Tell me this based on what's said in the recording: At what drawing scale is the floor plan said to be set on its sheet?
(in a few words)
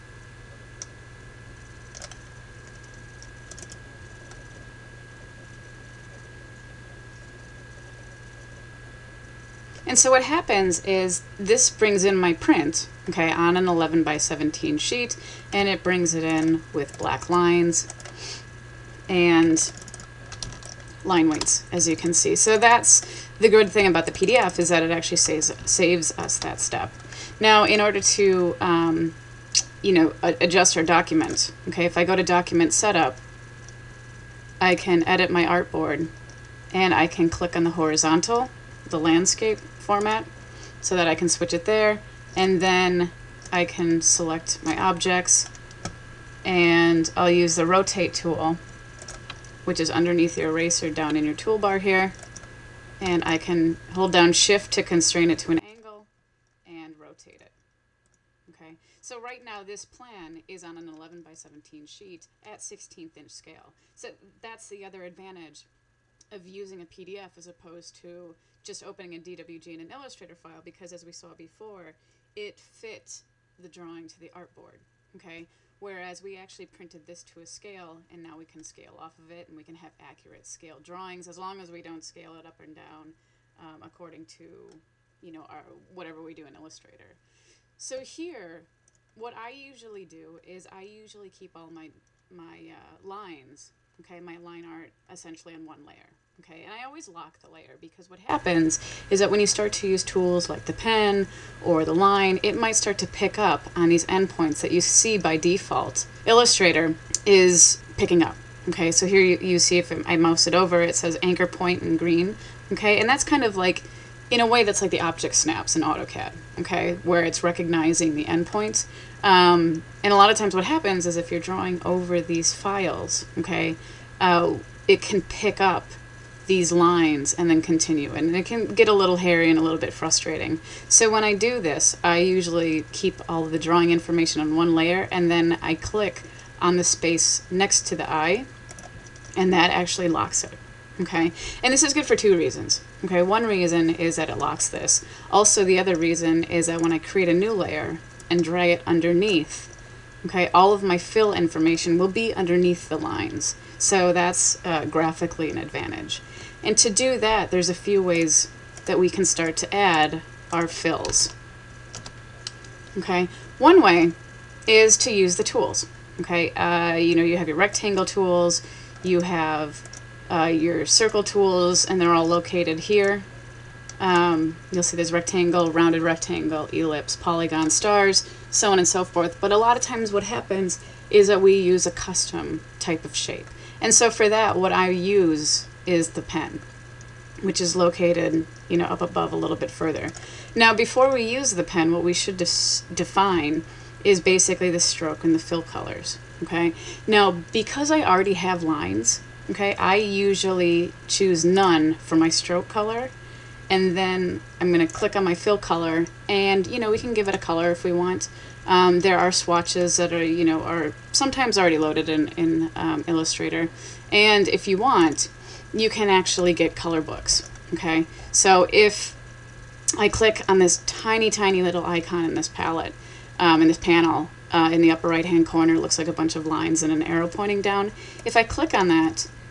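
16th inch.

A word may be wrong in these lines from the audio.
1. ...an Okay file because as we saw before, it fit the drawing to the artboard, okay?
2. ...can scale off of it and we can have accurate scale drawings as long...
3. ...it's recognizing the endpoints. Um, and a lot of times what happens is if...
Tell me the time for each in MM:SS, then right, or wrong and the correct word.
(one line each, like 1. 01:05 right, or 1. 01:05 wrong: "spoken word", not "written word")
1. 01:09 wrong: "Illustrator", not "Okay"
2. 01:18 right
3. 01:57 right.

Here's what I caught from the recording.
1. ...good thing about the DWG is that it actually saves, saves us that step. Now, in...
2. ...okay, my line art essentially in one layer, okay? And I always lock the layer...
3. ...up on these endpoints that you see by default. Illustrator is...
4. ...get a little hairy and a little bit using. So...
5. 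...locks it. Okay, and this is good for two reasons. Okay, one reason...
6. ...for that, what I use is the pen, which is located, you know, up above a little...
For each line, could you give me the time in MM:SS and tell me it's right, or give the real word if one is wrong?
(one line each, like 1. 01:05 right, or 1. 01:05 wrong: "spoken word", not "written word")
1. 00:23 wrong: "PDF", not "DWG"
2. 01:33 right
3. 01:43 right
4. 02:08 wrong: "frustrating", not "using"
5. 02:20 right
6. 03:04 right.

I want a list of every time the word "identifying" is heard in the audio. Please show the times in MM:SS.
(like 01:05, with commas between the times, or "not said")
not said.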